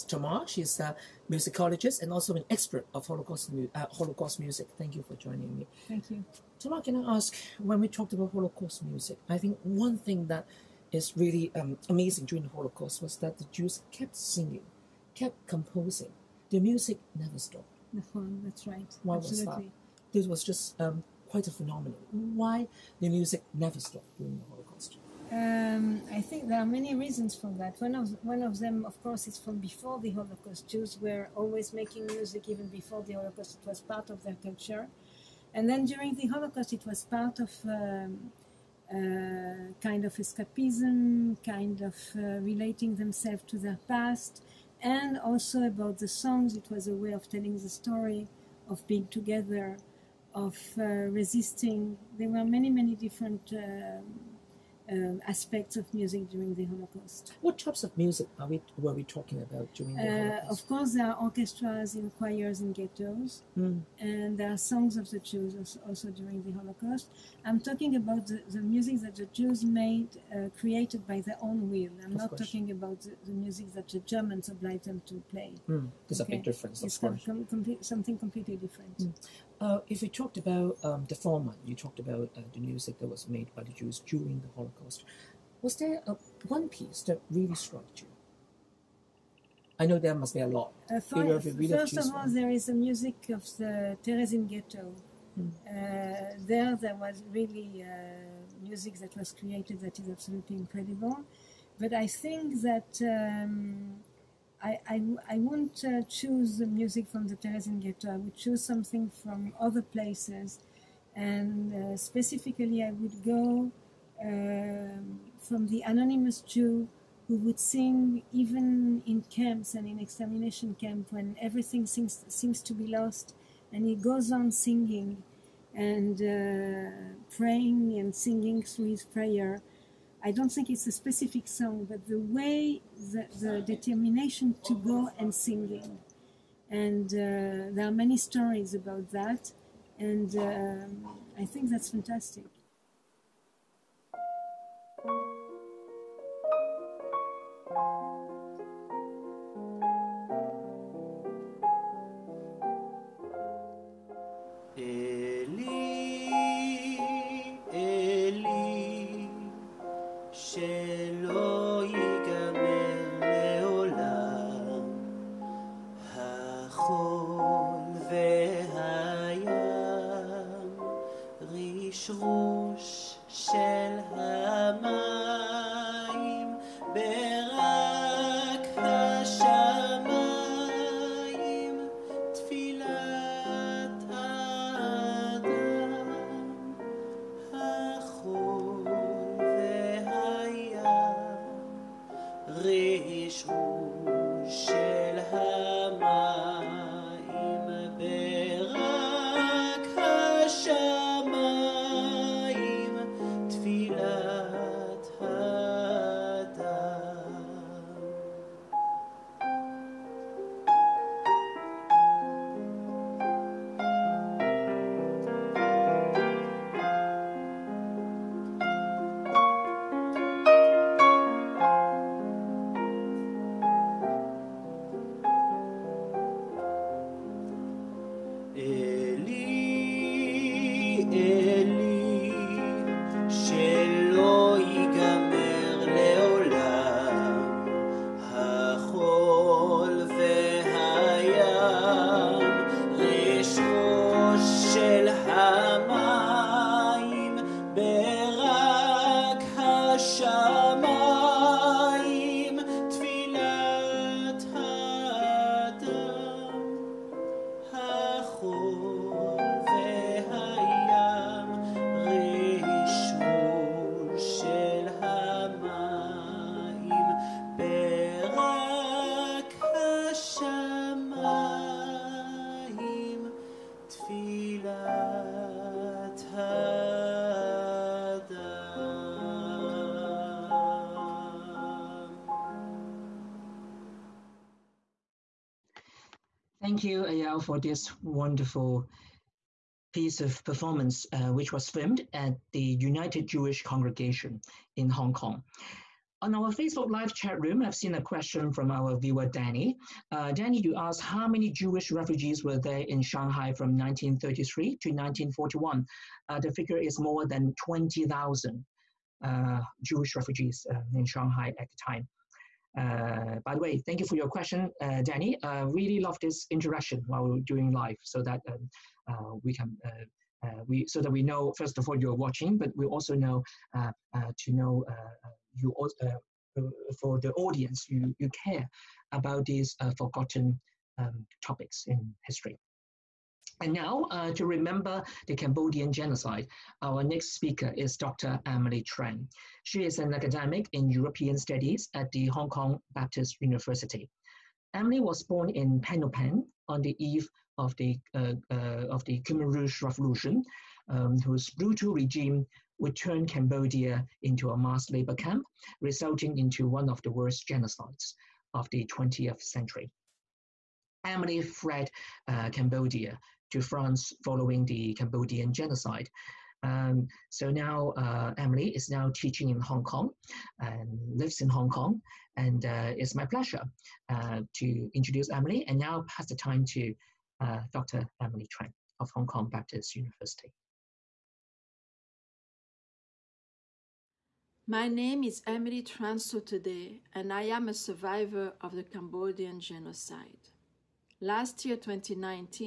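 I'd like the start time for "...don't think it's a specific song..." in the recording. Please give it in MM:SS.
02:10.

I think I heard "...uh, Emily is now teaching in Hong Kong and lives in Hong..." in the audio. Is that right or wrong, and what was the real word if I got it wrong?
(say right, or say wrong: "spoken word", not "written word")
right.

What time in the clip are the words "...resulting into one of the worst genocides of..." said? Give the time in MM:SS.
05:55.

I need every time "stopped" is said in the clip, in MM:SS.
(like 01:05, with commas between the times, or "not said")
00:17, 00:23.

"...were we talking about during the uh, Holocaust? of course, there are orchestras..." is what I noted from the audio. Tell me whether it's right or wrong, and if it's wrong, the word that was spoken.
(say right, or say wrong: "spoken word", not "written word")
right.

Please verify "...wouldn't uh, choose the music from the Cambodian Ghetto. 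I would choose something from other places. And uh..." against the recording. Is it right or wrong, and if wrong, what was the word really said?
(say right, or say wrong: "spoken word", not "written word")
wrong: "Terezin", not "Cambodian".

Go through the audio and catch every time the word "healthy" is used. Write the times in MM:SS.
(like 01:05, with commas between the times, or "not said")
not said.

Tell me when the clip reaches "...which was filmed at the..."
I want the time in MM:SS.
04:51.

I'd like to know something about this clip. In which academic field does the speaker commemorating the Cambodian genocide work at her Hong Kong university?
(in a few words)
European Studies.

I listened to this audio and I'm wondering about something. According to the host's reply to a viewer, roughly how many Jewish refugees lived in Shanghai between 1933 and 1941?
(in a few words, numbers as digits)
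more than 20,000.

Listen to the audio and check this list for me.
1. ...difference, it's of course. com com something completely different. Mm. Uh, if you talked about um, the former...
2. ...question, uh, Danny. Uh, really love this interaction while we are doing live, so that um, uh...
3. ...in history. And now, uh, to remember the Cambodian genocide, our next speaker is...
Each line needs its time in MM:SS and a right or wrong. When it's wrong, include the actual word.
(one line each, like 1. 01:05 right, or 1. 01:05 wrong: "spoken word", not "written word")
1. 01:16 right
2. 05:14 right
3. 05:31 right.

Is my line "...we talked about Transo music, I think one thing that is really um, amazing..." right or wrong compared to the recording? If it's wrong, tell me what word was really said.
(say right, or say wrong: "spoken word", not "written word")
wrong: "Holocaust", not "Transo".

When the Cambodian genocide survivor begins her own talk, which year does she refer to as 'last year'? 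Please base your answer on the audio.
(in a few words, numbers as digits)
2019.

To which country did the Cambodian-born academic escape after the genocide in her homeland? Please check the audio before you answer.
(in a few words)
France.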